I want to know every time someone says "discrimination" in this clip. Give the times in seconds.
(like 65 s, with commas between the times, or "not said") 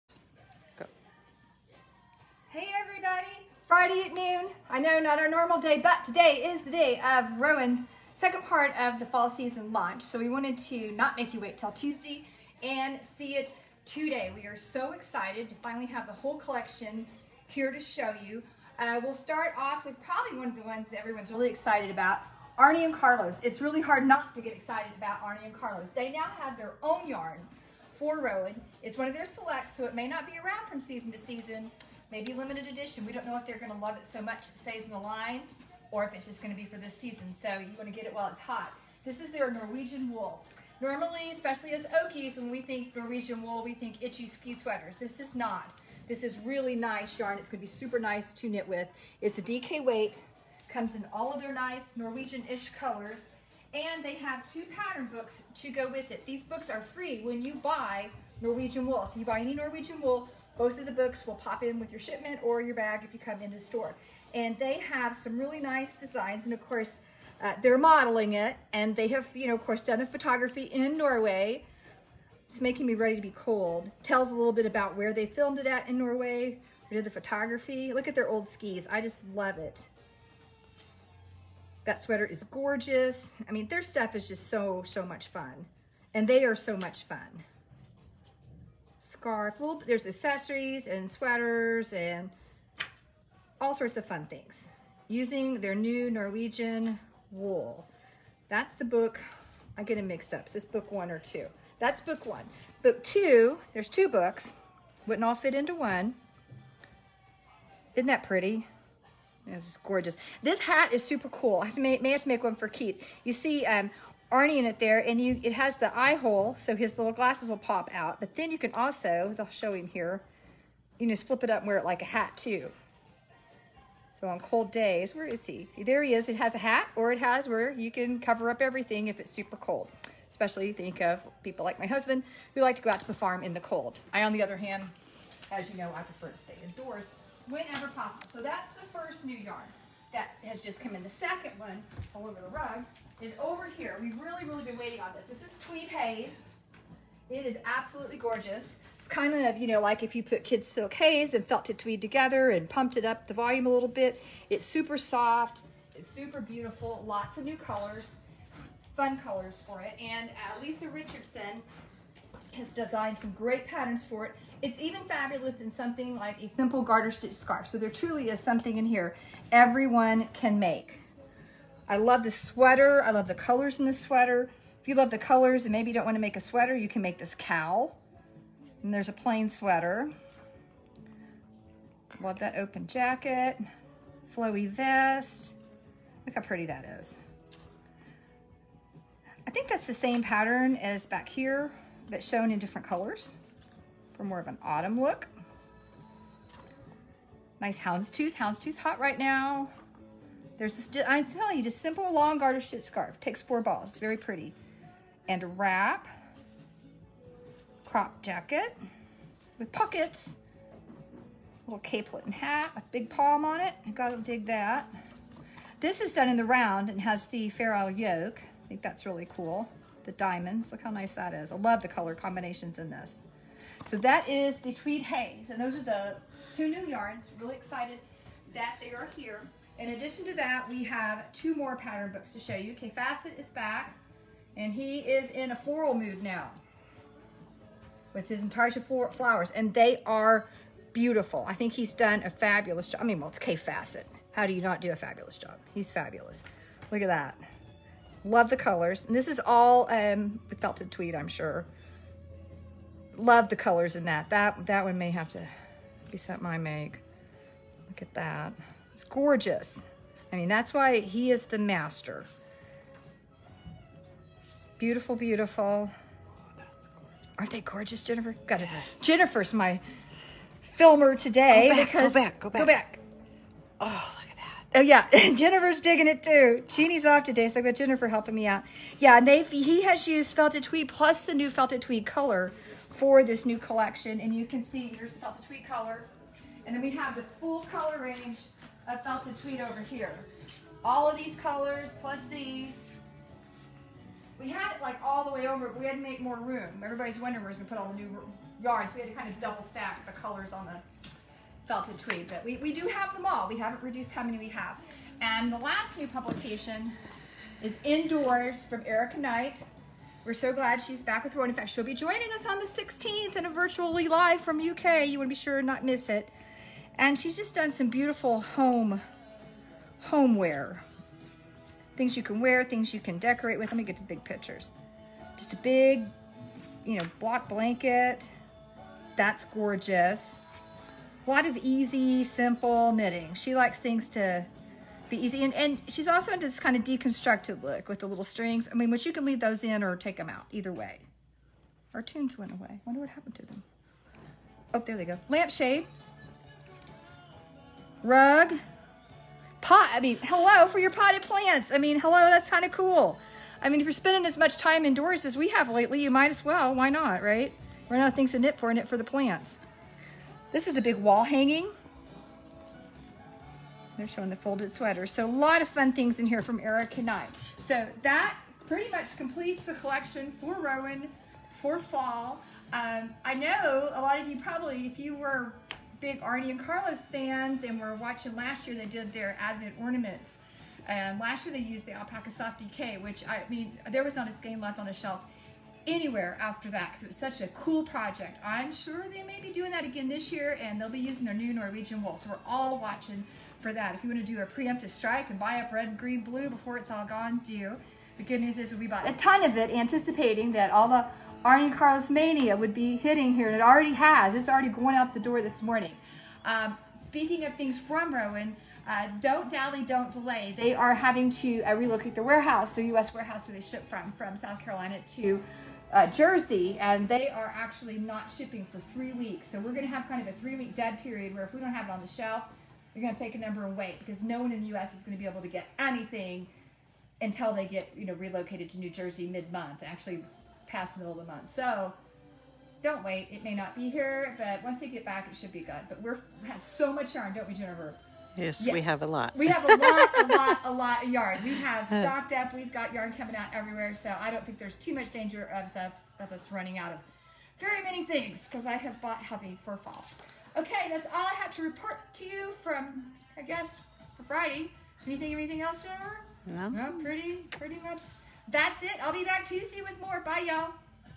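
not said.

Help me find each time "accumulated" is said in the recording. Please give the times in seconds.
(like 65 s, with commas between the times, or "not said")
not said.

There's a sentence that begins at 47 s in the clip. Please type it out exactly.
It's gonna be super nice to knit with.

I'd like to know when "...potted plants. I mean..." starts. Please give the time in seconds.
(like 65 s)
350 s.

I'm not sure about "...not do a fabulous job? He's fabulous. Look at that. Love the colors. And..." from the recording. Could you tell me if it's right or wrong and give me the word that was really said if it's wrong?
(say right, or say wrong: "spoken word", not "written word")
right.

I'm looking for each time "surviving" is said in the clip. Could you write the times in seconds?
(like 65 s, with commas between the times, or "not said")
not said.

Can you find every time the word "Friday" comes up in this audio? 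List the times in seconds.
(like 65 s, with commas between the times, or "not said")
3 s, 454 s.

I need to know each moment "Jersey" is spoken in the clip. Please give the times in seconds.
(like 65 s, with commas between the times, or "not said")
416 s, 428 s.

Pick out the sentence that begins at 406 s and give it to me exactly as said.
Um, speaking of things from Rowan, uh, don't dally, don't delay.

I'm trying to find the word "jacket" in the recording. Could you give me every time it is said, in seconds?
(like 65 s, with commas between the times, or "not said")
182 s, 208 s.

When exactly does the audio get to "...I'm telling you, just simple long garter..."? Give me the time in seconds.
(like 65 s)
201 s.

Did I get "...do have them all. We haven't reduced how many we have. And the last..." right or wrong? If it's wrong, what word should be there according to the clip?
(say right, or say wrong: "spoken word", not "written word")
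right.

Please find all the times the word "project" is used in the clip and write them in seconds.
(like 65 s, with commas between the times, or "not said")
387 s.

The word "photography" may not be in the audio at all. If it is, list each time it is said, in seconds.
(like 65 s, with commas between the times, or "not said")
70 s, 77 s.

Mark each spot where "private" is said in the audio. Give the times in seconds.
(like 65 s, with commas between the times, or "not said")
not said.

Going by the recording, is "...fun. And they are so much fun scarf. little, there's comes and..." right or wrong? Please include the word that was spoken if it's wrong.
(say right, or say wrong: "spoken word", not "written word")
wrong: "accessories", not "comes".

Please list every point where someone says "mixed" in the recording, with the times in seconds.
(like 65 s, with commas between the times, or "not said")
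100 s.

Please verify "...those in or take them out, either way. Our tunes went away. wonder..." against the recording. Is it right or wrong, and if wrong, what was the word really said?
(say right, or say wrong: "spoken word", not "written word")
right.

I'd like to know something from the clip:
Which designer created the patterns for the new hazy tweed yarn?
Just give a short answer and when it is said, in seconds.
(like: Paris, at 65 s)
Lisa Richardson, at 160 s.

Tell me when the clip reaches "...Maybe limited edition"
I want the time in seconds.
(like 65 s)
32 s.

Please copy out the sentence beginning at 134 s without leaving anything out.
I, on the other hand, as you know, I prefer to stay indoors whenever possible.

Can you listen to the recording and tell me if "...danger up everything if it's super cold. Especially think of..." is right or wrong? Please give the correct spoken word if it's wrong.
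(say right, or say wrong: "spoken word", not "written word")
wrong: "cover", not "danger".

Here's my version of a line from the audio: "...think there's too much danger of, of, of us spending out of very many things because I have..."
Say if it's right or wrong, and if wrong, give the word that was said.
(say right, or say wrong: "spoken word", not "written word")
wrong: "running", not "spending".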